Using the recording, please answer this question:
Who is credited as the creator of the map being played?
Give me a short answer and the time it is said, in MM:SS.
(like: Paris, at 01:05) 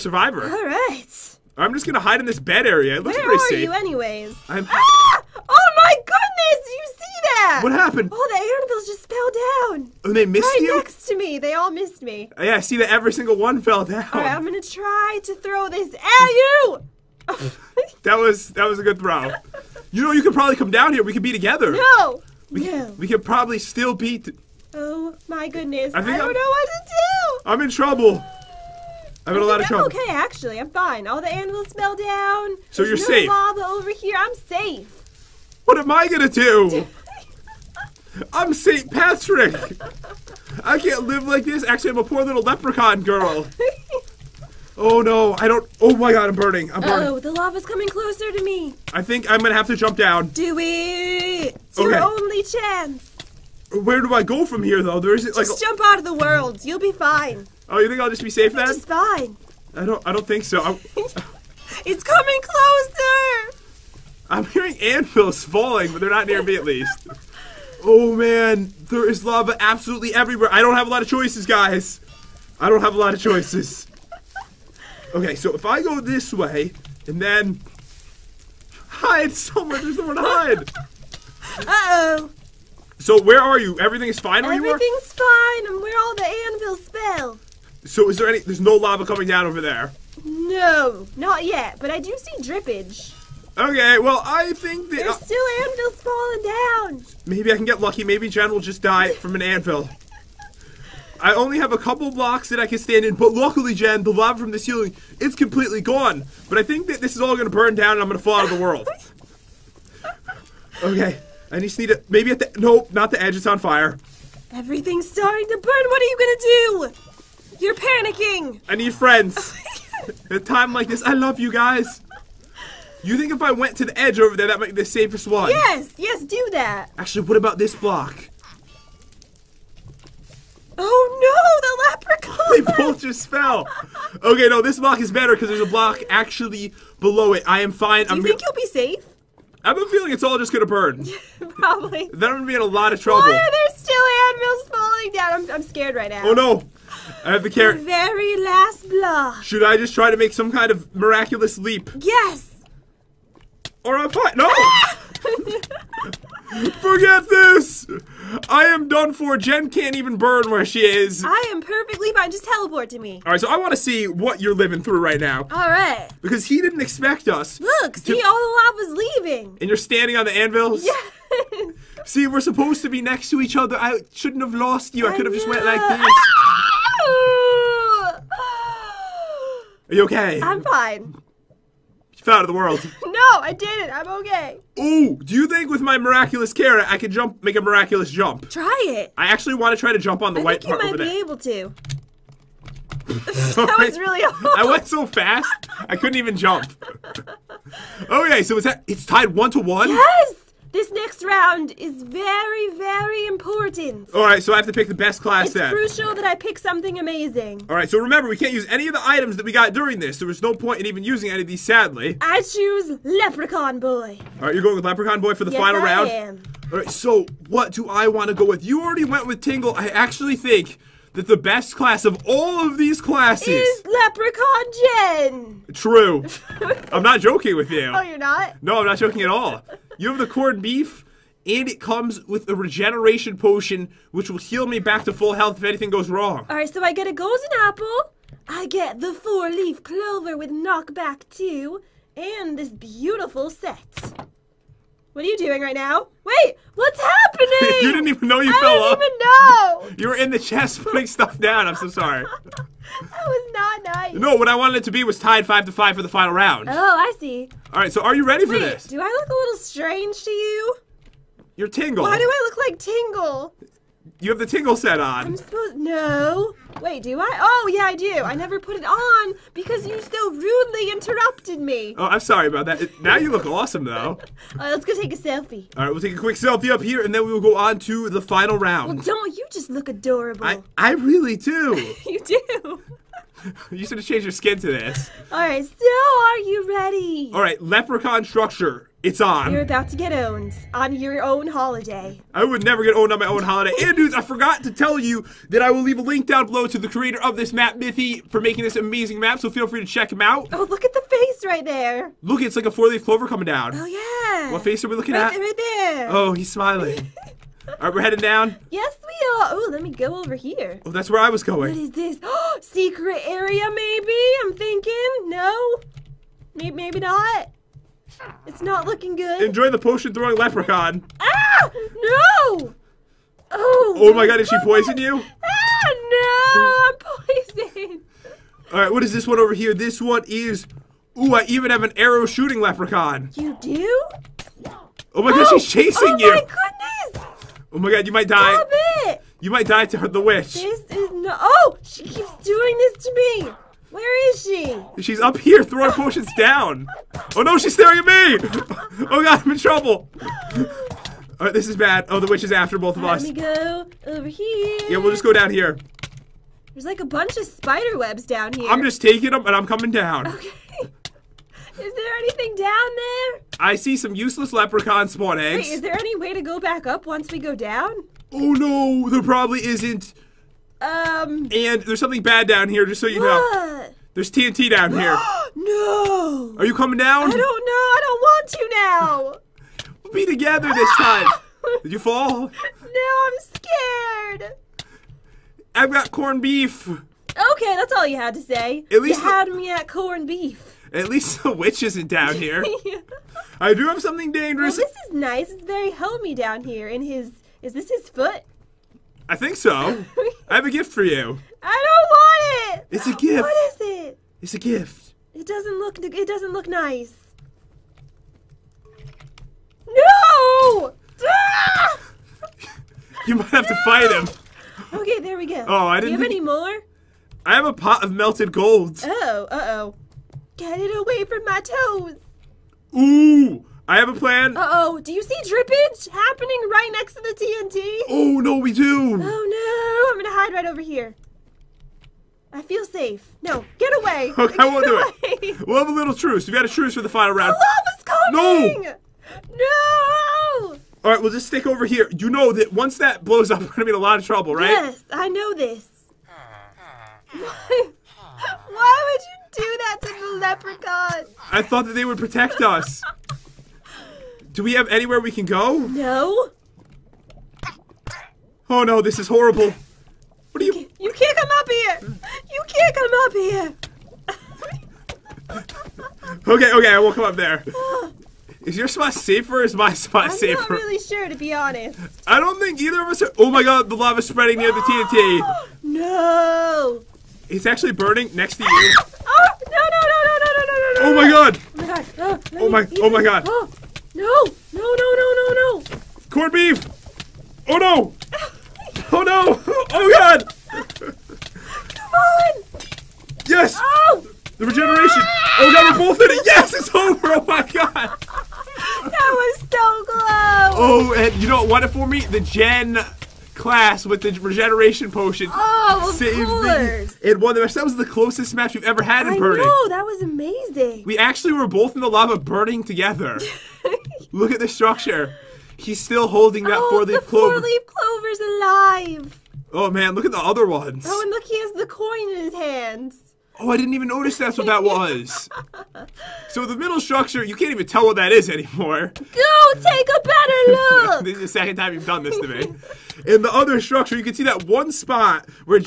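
Miffy, at 04:57.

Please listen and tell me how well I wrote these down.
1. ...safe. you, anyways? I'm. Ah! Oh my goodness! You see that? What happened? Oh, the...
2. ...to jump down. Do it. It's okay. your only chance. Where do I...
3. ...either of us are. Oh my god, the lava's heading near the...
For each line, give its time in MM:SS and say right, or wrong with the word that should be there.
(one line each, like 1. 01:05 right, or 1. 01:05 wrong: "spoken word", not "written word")
1. 00:03 right
2. 00:49 right
3. 07:52 wrong: "spreading", not "heading".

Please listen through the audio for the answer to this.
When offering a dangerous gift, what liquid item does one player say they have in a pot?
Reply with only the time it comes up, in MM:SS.
06:57.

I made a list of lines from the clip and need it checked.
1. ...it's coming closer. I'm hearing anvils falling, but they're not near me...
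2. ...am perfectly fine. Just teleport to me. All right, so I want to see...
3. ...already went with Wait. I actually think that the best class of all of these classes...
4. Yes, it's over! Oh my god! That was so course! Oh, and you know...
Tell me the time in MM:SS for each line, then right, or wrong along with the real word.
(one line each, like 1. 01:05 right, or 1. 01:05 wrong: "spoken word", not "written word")
1. 01:01 right
2. 02:41 right
3. 03:38 wrong: "Tingle", not "Wait"
4. 08:16 wrong: "close", not "course".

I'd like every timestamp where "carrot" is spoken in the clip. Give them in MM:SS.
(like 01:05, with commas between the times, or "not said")
02:27, 03:06.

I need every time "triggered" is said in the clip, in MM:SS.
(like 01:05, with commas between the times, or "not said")
not said.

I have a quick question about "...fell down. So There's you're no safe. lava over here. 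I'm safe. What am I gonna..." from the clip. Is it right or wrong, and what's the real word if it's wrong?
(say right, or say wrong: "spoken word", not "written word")
right.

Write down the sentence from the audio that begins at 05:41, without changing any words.
Oh, she keeps doing this to me.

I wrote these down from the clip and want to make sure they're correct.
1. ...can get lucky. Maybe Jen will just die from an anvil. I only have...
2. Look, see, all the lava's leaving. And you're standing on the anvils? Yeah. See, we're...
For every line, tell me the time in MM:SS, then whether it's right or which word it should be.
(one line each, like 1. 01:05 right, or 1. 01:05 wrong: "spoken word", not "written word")
1. 01:37 right
2. 02:47 right.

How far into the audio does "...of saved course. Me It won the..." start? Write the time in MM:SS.
08:26.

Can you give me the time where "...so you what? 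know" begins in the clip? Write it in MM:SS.
06:13.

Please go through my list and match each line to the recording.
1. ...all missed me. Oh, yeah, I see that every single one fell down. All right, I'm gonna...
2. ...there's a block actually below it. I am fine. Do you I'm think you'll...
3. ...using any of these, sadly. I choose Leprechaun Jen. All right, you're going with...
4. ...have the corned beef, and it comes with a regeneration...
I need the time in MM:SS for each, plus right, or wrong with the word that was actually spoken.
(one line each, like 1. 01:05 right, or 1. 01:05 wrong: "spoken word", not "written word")
1. 00:11 right
2. 02:15 right
3. 03:31 wrong: "Boy", not "Jen"
4. 03:50 right.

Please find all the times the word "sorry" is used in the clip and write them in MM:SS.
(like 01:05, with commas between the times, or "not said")
04:11, 04:32.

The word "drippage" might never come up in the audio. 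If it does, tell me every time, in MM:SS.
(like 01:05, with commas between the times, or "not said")
01:32, 07:05.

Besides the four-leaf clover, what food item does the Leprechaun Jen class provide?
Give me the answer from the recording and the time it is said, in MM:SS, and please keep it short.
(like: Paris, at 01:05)
Golden apple, at 03:57.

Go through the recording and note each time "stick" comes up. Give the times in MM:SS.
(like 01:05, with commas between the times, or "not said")
07:21.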